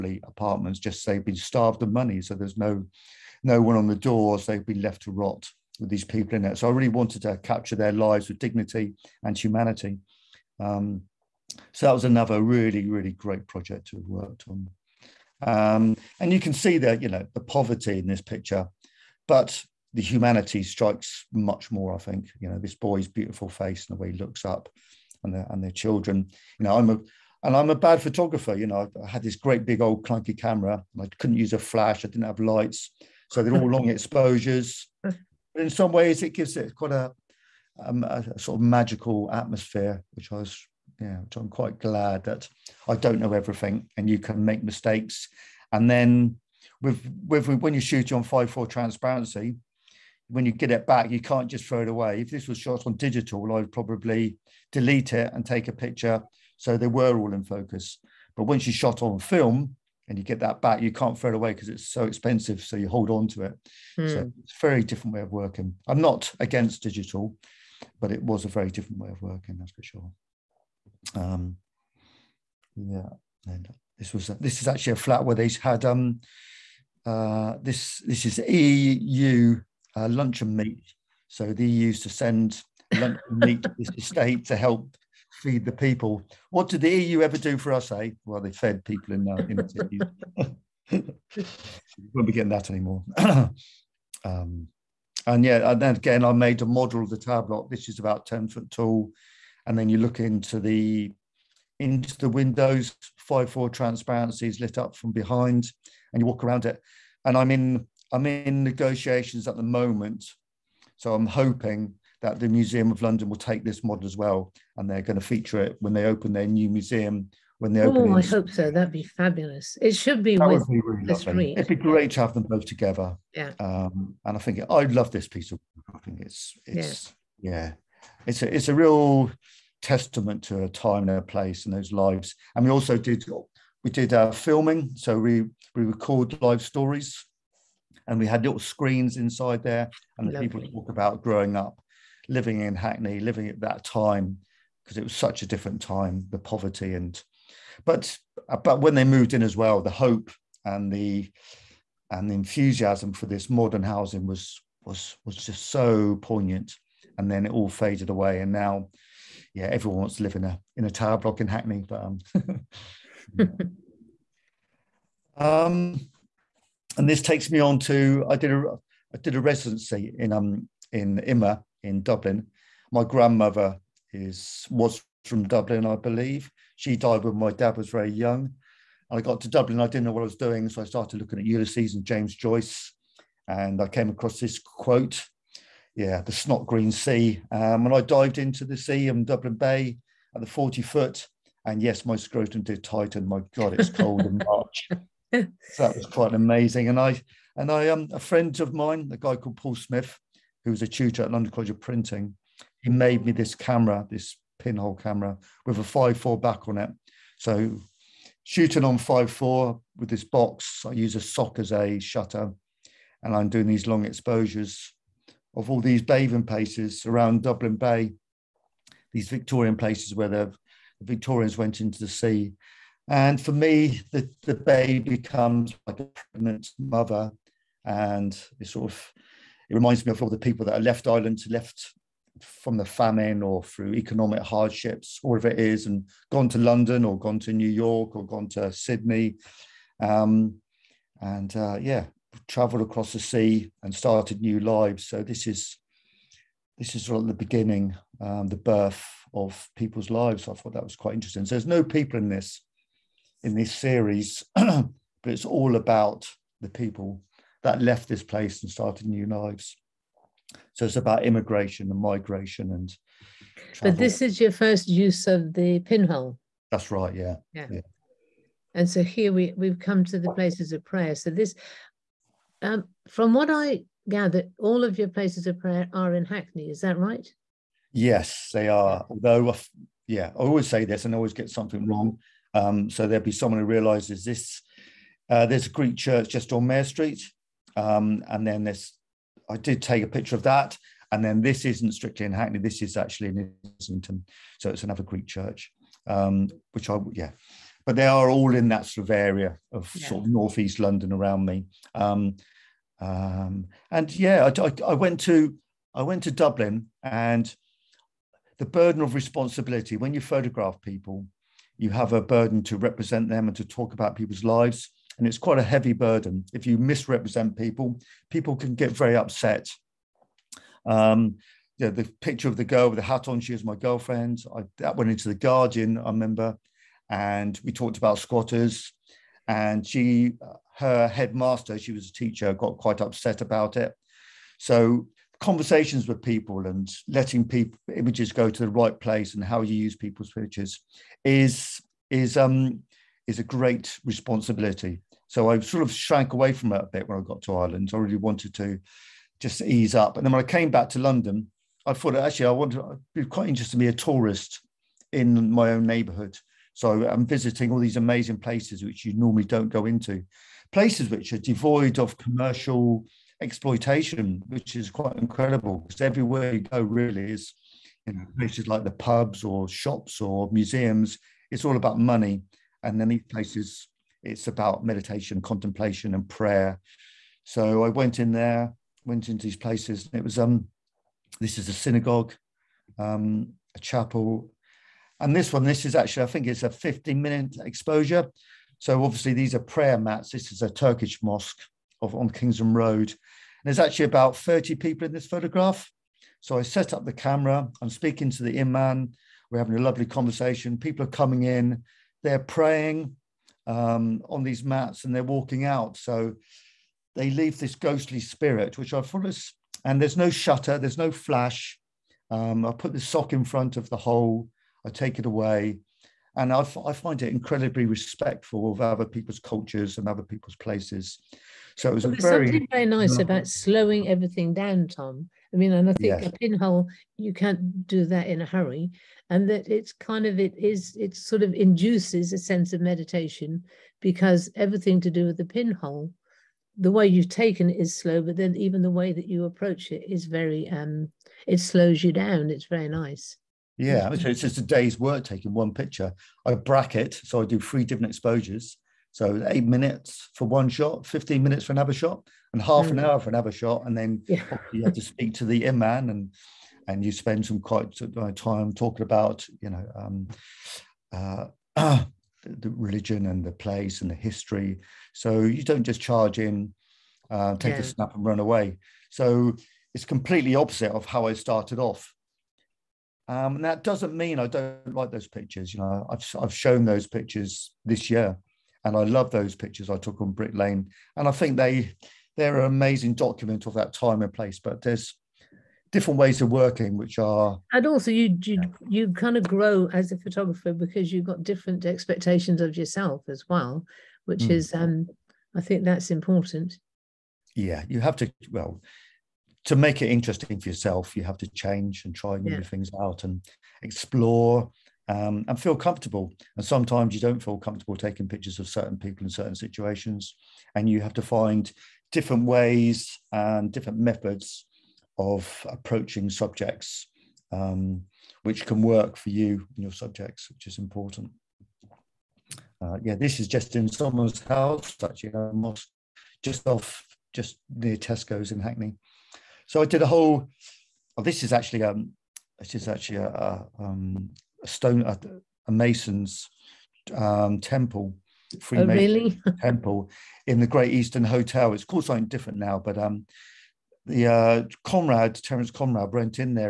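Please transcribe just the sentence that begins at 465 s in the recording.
So you don't just charge in, uh, take yeah.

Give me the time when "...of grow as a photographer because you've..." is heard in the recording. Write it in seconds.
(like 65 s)
489 s.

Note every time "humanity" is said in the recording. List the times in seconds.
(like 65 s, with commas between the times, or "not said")
9 s, 20 s.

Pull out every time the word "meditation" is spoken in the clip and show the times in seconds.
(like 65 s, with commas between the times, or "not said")
374 s, 432 s.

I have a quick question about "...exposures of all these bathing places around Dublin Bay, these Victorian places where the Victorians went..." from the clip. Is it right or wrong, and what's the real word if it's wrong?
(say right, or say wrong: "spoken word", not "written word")
right.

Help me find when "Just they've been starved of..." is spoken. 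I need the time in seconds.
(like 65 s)
0 s.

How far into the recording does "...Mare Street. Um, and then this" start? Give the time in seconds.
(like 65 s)
286 s.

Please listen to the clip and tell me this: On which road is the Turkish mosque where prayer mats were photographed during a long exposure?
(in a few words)
Kingsland Road.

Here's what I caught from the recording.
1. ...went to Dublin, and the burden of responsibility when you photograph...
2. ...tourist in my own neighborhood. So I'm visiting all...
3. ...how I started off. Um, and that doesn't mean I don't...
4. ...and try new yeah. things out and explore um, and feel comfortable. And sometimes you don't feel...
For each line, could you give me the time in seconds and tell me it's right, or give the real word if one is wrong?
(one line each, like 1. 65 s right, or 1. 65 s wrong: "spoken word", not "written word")
1. 306 s right
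2. 353 s right
3. 471 s right
4. 502 s right.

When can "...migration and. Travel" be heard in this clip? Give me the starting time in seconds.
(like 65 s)
261 s.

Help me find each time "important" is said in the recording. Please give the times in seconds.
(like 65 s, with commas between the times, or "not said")
496 s, 520 s.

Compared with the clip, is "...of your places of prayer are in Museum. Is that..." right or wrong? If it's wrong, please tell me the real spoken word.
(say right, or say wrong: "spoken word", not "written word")
wrong: "Hackney", not "Museum".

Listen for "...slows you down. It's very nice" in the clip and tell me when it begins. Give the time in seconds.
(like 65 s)
441 s.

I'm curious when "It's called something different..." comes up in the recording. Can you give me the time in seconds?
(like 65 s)
541 s.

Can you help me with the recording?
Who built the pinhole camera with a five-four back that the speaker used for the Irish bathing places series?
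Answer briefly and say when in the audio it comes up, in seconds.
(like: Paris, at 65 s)
Paul Smith, at 199 s.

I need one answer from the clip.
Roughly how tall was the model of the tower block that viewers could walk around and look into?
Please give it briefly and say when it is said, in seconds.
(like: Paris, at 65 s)
10 feet, at 98 s.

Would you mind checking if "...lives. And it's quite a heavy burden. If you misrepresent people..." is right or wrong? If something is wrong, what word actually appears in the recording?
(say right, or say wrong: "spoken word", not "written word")
right.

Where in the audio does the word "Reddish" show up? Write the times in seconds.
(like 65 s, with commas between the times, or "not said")
not said.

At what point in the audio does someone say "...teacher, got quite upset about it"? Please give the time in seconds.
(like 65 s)
332 s.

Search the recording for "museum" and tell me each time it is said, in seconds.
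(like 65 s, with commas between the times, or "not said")
112 s, 116 s, 370 s.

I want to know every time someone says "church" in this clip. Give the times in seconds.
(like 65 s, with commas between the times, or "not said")
285 s, 295 s.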